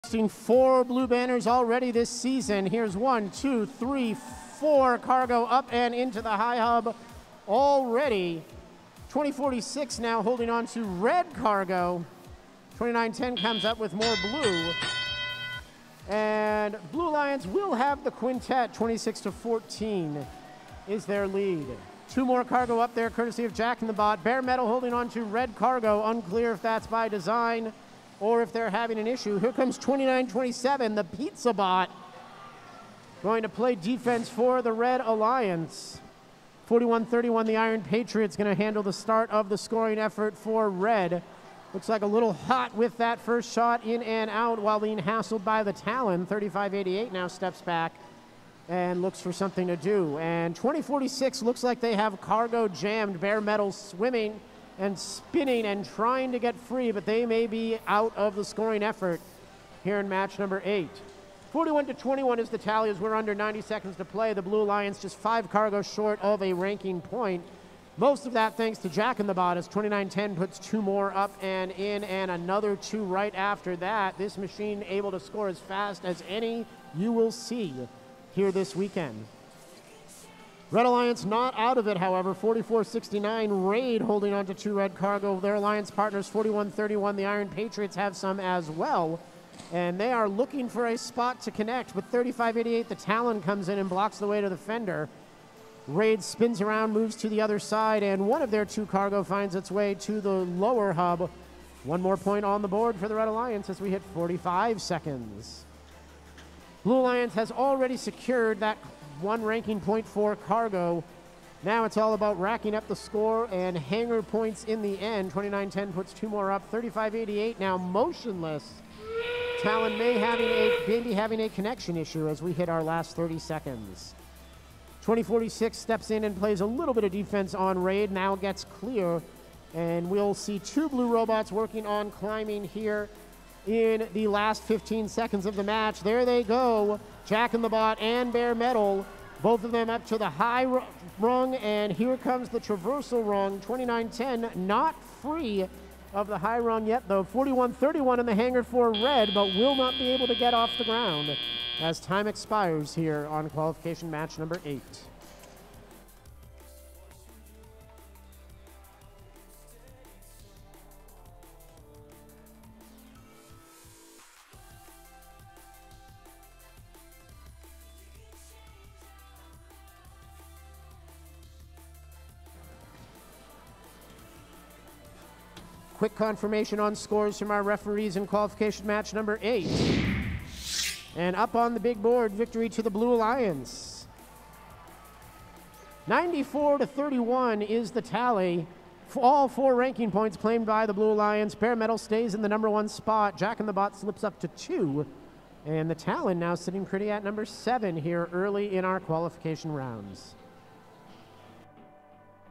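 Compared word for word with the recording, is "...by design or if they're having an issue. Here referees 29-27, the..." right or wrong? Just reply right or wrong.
wrong.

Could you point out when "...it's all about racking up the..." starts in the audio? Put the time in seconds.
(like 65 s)
111 s.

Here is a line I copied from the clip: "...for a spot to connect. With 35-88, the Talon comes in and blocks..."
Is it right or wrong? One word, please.
right.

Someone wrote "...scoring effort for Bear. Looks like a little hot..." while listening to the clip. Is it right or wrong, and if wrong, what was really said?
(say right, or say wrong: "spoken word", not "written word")
wrong: "Red", not "Bear".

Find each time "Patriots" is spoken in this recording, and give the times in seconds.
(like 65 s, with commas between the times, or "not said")
37 s, 87 s.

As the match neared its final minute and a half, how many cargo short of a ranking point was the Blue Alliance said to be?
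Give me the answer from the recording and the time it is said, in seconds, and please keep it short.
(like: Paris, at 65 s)
5, at 65 s.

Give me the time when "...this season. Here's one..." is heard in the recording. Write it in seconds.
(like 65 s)
1 s.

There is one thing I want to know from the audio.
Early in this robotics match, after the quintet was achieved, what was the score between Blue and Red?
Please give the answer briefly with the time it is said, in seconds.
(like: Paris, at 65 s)
26 to 14, at 18 s.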